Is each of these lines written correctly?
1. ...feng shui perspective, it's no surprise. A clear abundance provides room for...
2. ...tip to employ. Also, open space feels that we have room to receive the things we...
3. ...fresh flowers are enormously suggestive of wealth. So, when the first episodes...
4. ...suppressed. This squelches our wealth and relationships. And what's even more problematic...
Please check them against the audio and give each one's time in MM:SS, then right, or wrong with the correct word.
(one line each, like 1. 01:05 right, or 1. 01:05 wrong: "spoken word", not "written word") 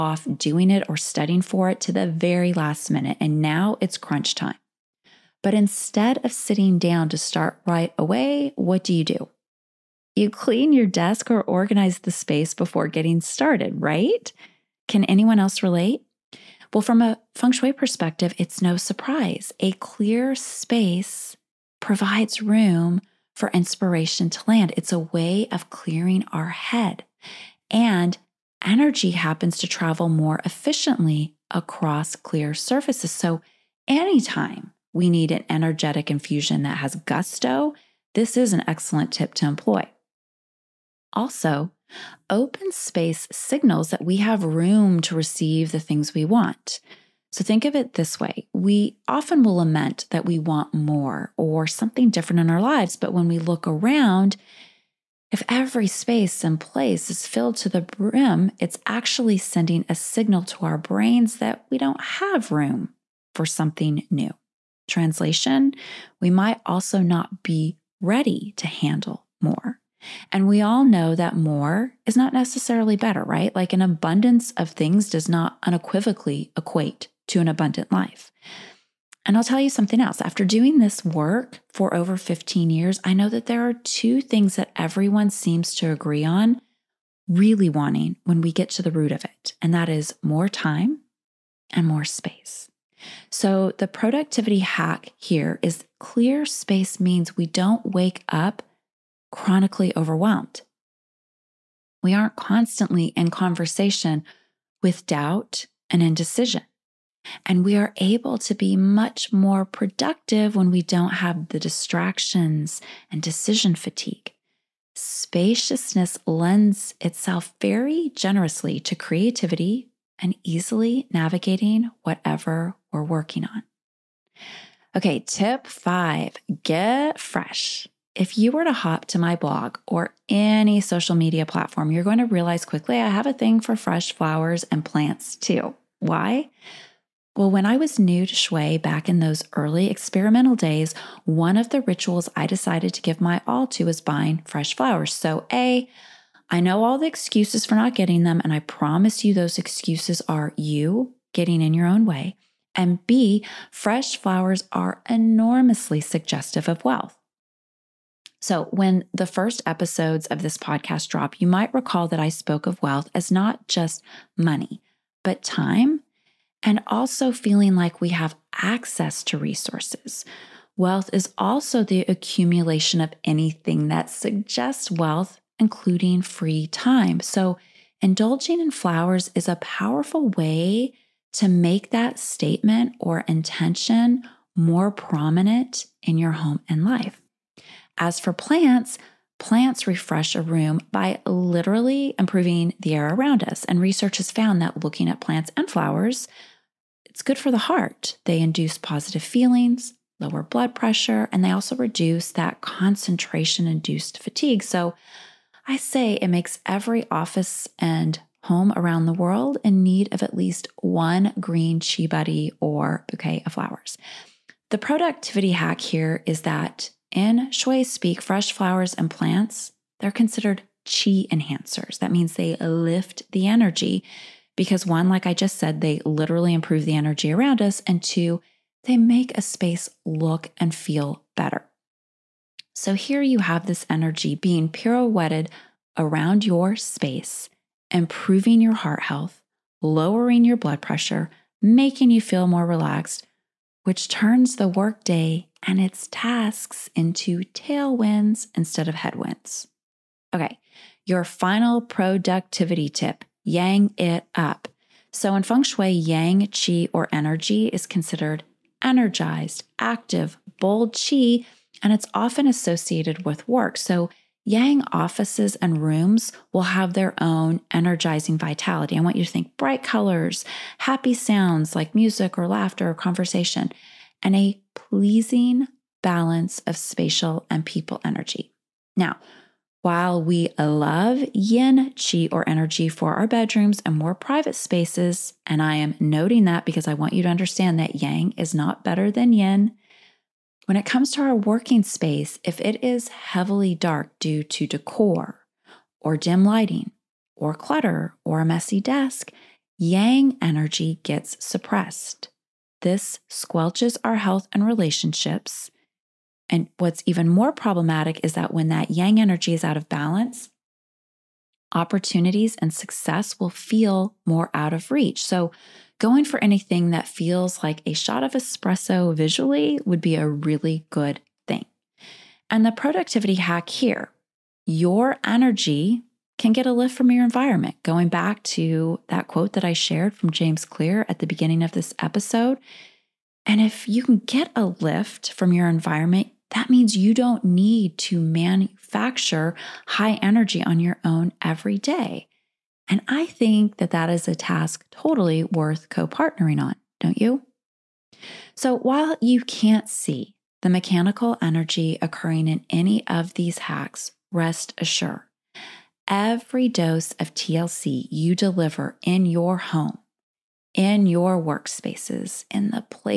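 1. 00:17 wrong: "space", not "abundance"
2. 00:39 wrong: "signals", not "feels"
3. 02:33 right
4. 05:01 wrong: "health", not "wealth".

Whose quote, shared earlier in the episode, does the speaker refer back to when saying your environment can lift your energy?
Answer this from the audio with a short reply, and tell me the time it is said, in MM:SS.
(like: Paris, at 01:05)
James Clear, at 05:30.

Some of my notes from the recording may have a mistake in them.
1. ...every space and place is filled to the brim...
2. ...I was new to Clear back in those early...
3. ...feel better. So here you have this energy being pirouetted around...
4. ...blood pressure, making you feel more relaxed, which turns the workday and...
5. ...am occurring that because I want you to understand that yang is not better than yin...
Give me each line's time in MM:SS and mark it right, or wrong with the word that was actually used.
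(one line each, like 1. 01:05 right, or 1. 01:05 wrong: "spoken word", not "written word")
1. 00:55 right
2. 02:17 wrong: "Shui", not "Clear"
3. 03:50 right
4. 04:00 right
5. 04:45 wrong: "noting", not "occurring".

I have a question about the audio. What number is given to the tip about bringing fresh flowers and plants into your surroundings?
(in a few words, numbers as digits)
5.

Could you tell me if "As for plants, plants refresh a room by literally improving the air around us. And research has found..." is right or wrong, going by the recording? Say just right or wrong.
right.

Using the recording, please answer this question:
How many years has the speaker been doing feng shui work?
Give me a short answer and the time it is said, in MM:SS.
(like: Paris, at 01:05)
15, at 01:22.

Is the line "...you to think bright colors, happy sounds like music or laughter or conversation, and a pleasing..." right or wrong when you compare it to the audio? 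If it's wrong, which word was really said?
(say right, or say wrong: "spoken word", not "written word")
right.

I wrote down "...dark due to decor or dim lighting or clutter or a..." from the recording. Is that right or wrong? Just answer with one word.
right.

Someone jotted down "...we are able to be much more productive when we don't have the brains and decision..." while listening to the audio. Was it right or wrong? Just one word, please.
wrong.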